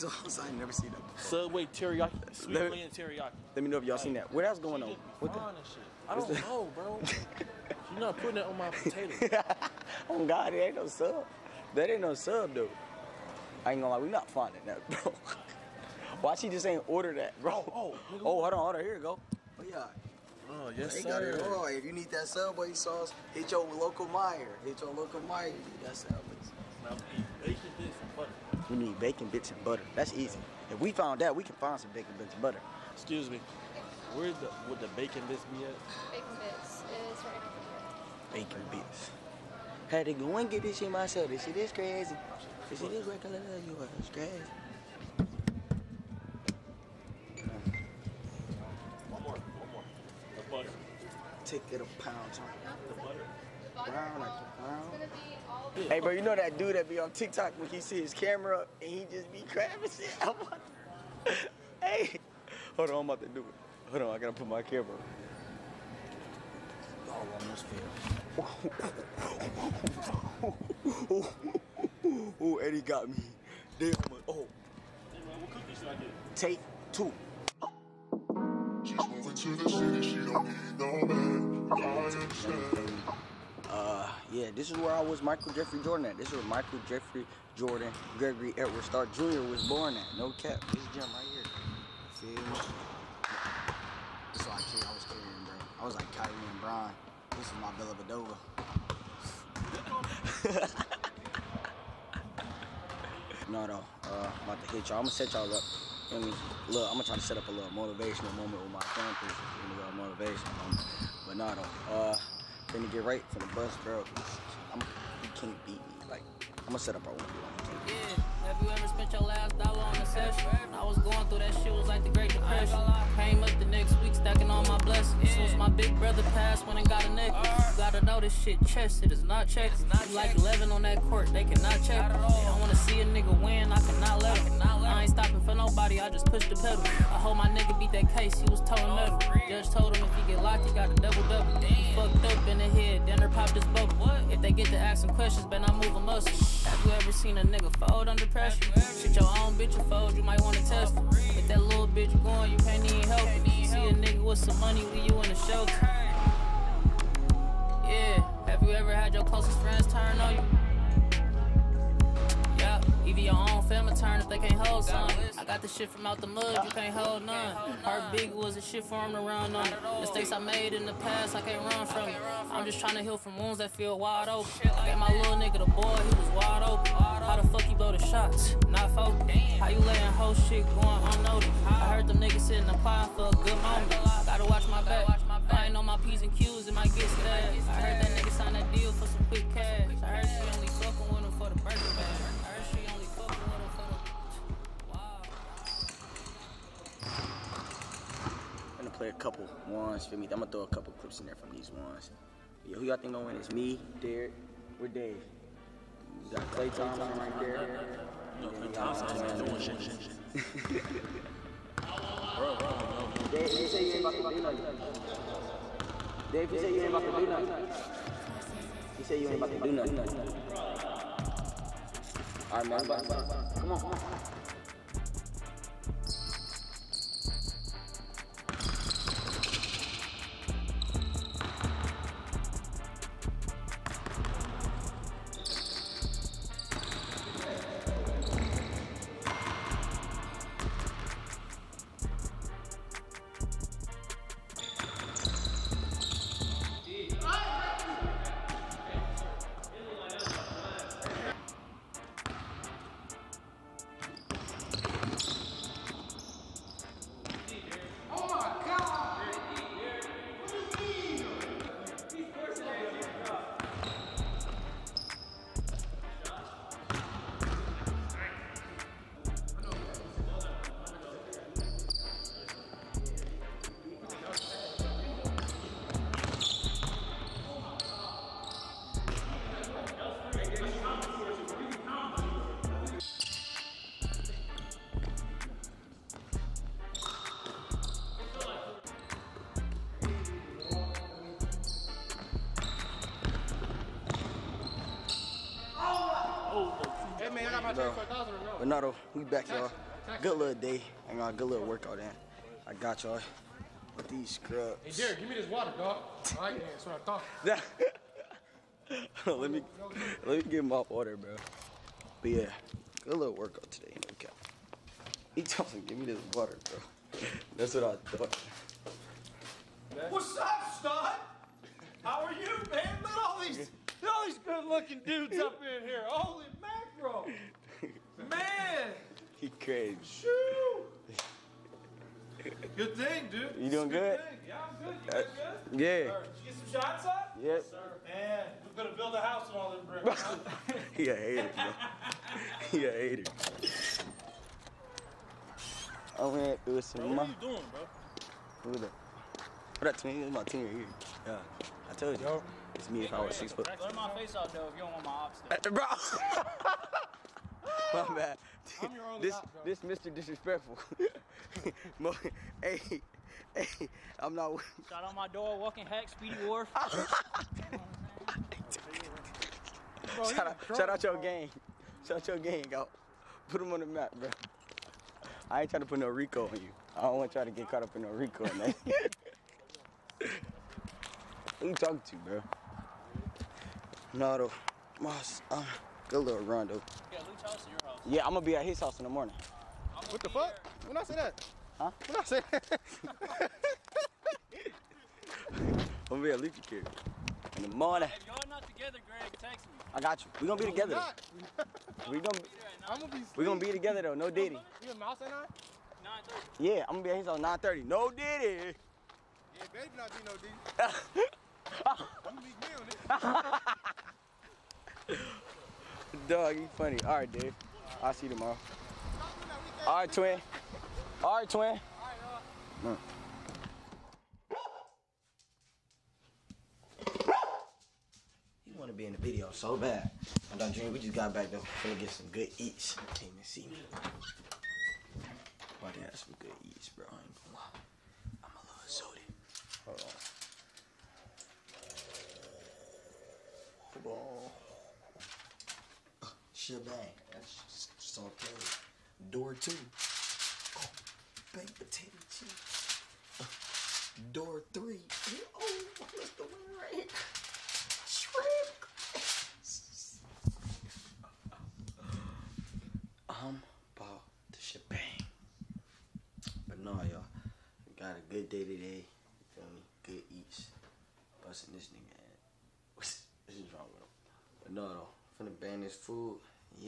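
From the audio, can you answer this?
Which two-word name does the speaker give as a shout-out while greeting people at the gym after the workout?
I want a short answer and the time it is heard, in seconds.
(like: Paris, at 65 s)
Speedy Wharf, at 366 s.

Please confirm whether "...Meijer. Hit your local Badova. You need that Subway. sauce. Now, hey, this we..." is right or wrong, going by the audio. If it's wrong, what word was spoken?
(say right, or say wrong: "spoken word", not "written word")
wrong: "Meijer", not "Badova".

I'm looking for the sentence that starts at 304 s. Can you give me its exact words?
Hey, Derek, give me this water, dog.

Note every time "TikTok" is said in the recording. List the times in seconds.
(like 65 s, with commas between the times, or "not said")
57 s.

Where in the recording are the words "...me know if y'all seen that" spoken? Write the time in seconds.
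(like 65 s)
3 s.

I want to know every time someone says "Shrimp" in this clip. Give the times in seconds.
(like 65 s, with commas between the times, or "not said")
458 s.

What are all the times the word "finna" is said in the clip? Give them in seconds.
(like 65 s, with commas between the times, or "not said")
112 s, 475 s.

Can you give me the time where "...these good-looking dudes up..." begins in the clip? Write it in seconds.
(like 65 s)
324 s.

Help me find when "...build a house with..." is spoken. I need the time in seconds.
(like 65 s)
338 s.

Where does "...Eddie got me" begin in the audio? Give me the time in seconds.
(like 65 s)
72 s.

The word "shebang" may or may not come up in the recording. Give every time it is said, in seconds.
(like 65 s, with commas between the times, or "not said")
446 s, 464 s.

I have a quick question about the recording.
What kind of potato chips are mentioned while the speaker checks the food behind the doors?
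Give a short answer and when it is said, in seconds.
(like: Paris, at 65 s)
Baked, at 451 s.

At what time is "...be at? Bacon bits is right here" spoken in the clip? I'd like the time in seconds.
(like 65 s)
35 s.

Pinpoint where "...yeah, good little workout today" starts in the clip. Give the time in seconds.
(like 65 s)
312 s.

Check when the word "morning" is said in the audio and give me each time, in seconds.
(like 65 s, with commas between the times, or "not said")
389 s, 397 s.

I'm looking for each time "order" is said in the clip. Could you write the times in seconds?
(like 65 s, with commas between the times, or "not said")
16 s.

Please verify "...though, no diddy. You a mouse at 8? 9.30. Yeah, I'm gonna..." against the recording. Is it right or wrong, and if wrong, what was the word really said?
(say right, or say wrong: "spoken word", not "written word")
wrong: "9", not "8".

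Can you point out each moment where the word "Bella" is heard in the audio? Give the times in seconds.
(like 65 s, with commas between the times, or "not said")
97 s.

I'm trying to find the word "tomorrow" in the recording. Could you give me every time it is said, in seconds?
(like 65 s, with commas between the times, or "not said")
418 s.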